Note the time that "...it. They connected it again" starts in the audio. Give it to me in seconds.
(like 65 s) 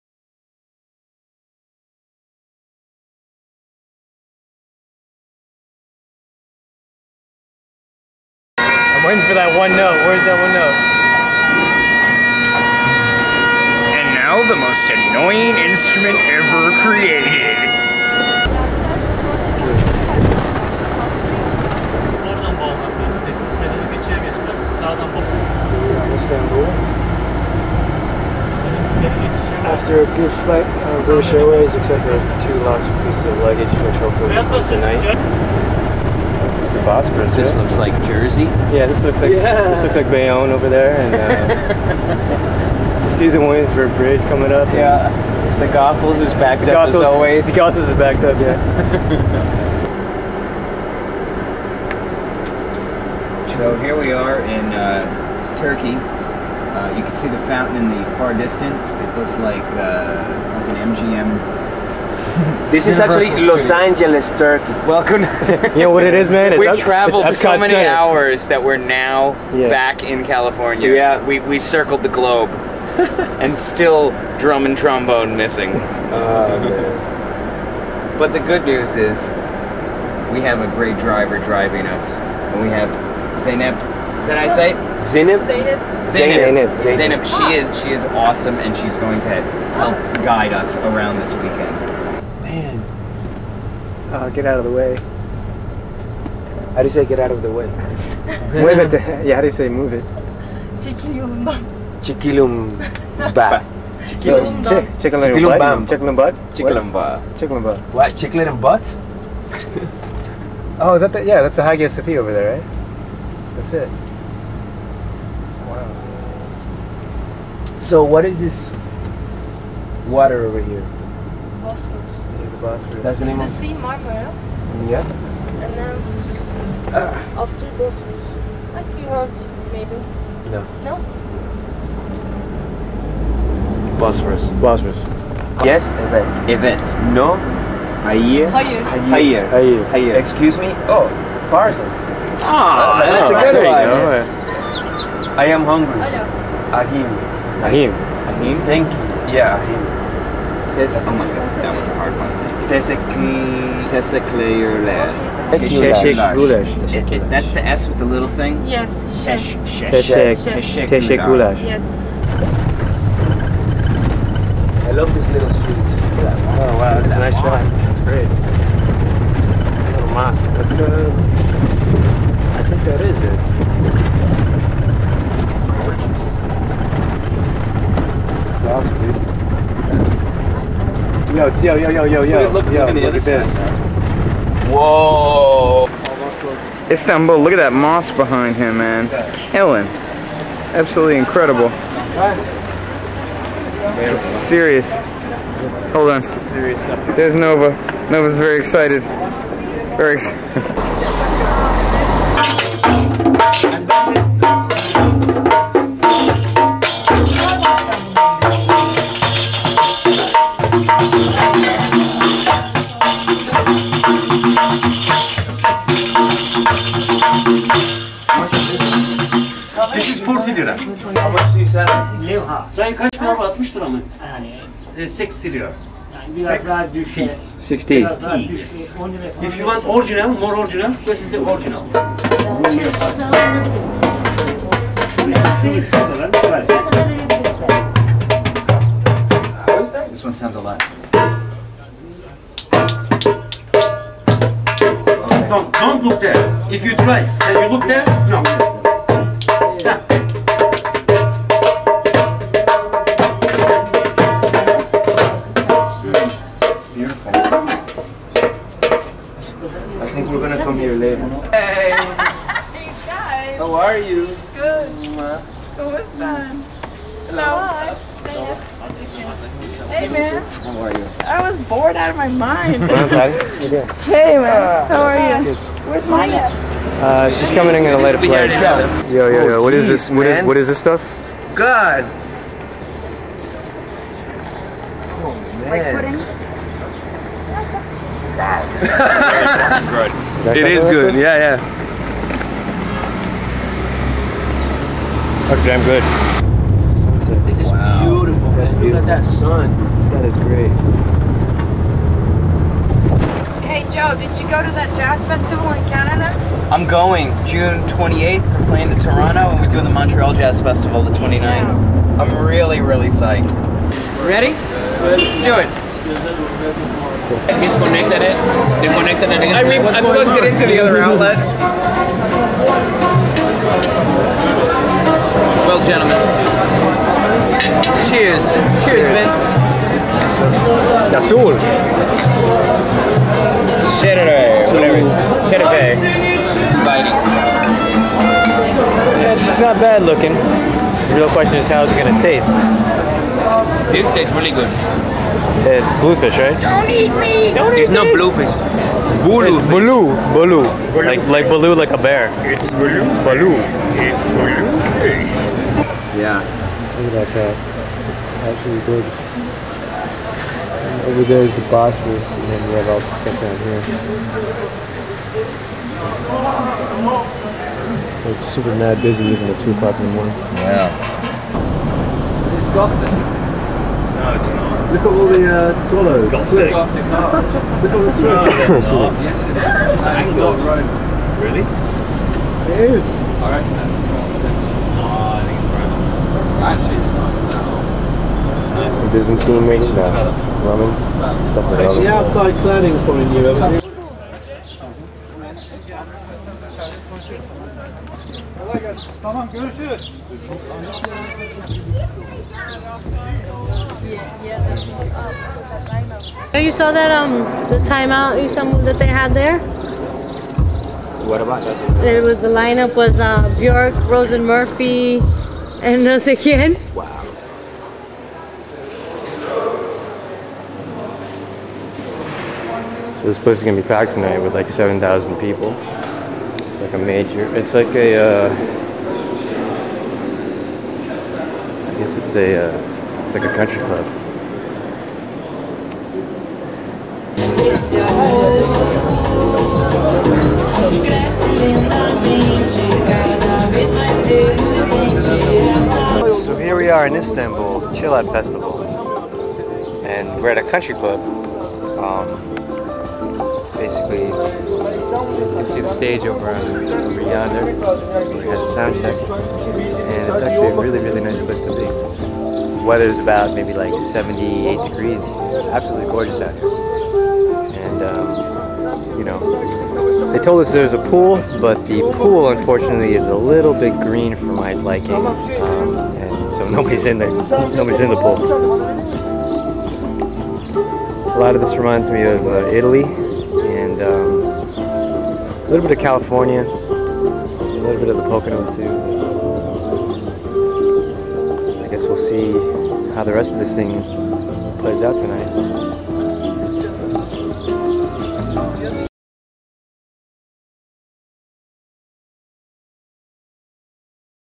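318 s.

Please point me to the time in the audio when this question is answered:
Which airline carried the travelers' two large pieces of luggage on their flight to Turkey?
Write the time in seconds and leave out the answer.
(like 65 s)
31 s.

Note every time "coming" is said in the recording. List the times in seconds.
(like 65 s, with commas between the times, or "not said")
44 s, 277 s.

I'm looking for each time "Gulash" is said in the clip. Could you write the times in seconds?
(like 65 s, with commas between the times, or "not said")
156 s, 161 s.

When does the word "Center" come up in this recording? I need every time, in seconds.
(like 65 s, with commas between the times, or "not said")
67 s.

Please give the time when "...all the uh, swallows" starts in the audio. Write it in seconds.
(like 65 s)
375 s.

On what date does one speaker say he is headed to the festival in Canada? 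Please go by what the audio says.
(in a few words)
June 28th.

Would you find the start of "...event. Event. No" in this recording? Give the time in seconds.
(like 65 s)
136 s.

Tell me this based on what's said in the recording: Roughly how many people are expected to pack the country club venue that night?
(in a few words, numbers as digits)
7,000.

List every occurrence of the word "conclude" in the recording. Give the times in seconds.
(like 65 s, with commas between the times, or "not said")
not said.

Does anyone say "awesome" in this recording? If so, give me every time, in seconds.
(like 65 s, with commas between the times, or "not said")
88 s.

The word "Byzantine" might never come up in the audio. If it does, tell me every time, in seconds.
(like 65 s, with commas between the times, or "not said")
389 s.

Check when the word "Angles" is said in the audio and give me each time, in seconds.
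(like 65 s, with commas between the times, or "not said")
380 s.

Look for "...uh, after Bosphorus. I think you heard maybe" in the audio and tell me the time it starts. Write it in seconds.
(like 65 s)
126 s.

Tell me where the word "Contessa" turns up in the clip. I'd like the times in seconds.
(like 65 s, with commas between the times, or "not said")
not said.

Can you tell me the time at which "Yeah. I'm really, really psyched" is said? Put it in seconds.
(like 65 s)
311 s.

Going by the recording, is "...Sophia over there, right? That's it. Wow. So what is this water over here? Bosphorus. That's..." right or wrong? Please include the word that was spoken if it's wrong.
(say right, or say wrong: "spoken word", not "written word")
right.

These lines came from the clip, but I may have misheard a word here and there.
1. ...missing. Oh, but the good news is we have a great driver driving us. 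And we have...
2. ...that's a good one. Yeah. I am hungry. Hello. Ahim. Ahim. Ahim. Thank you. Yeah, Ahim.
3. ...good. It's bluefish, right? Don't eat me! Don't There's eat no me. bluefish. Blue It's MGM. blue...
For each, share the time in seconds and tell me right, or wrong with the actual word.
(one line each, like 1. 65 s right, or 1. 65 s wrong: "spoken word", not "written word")
1. 75 s right
2. 143 s right
3. 344 s wrong: "Blue", not "MGM".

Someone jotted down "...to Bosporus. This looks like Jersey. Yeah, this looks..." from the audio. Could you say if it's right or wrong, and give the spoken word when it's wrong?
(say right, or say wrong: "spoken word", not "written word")
right.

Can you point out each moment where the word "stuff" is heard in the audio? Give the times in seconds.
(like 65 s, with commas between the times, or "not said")
280 s, 363 s, 391 s.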